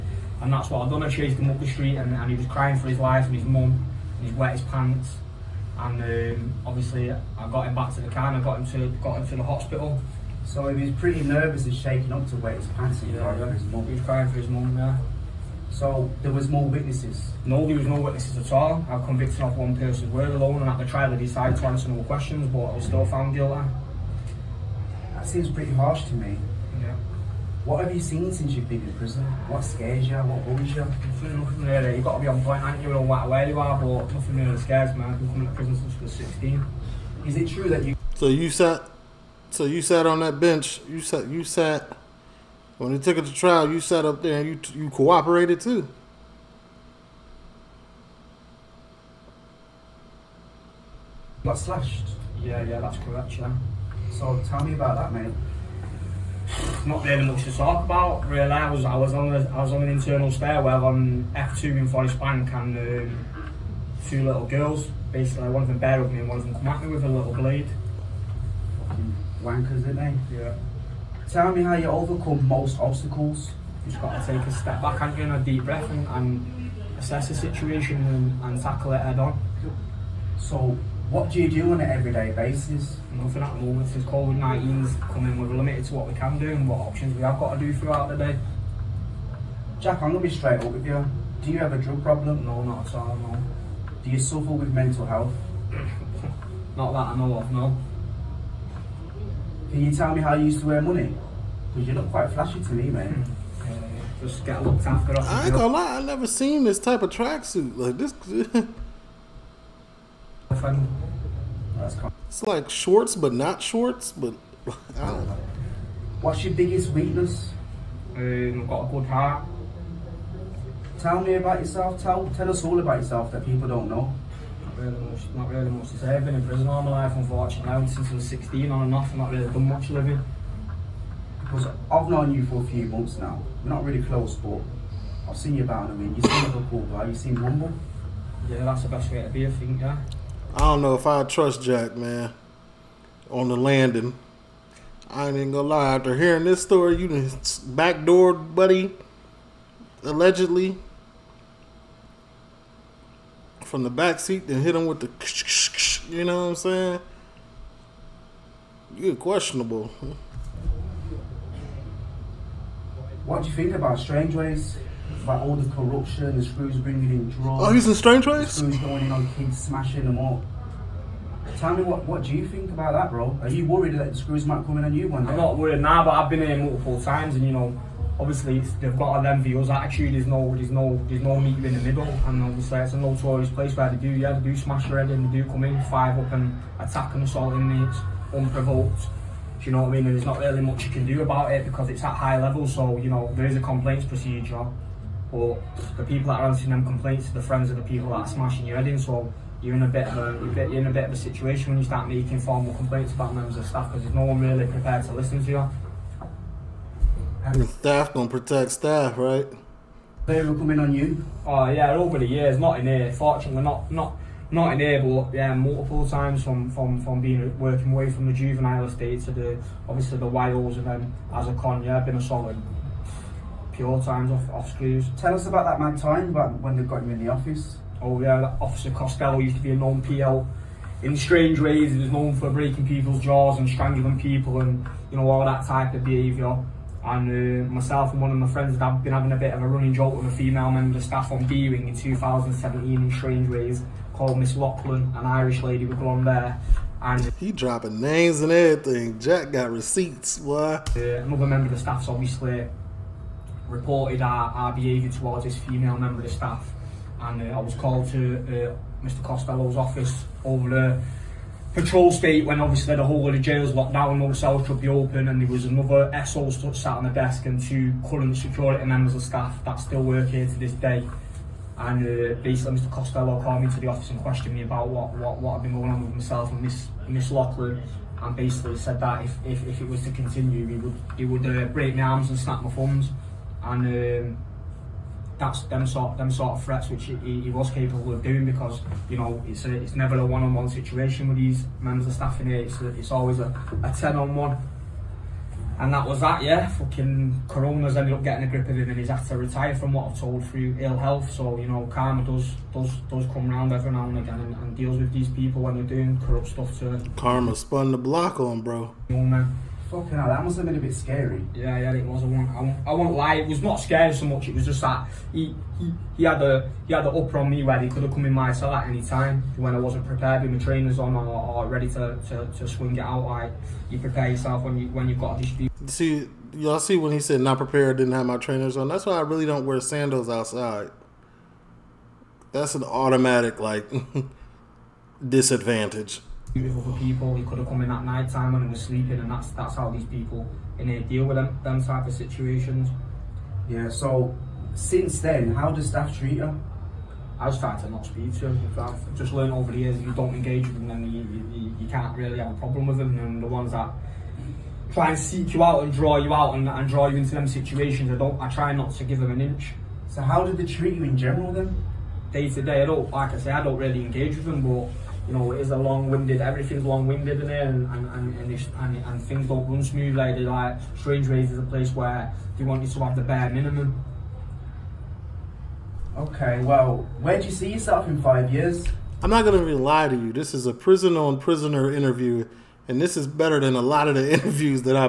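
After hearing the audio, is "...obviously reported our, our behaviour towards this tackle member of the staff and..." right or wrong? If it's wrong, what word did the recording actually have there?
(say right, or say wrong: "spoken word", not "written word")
wrong: "female", not "tackle".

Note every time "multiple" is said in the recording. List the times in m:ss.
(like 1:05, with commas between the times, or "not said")
2:56, 3:35.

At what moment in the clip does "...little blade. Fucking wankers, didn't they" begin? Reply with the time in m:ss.
1:07.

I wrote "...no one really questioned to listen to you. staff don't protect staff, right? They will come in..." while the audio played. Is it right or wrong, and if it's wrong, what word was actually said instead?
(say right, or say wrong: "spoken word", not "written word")
wrong: "prepared", not "questioned".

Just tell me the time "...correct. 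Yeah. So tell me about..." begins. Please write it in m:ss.
0:52.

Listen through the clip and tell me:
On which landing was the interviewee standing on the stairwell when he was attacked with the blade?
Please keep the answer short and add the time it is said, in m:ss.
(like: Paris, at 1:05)
F2, at 1:01.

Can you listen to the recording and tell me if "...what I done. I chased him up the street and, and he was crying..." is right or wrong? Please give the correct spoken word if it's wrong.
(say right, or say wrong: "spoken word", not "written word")
right.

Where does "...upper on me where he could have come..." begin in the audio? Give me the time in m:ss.
5:17.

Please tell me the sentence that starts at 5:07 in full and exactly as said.
Karma spun the block on, bro.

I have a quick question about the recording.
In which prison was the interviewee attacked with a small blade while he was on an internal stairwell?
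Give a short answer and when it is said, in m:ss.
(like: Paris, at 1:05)
Forest Bank, at 1:01.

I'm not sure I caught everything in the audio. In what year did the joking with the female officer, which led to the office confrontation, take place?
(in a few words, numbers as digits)
2017.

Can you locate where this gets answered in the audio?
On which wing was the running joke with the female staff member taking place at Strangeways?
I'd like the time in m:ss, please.
4:01.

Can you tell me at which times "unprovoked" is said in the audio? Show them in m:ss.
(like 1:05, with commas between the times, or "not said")
3:08.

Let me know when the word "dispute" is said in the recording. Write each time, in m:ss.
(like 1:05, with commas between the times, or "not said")
5:25.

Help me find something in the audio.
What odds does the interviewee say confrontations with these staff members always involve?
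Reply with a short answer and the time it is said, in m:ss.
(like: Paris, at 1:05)
Ten on one, at 4:53.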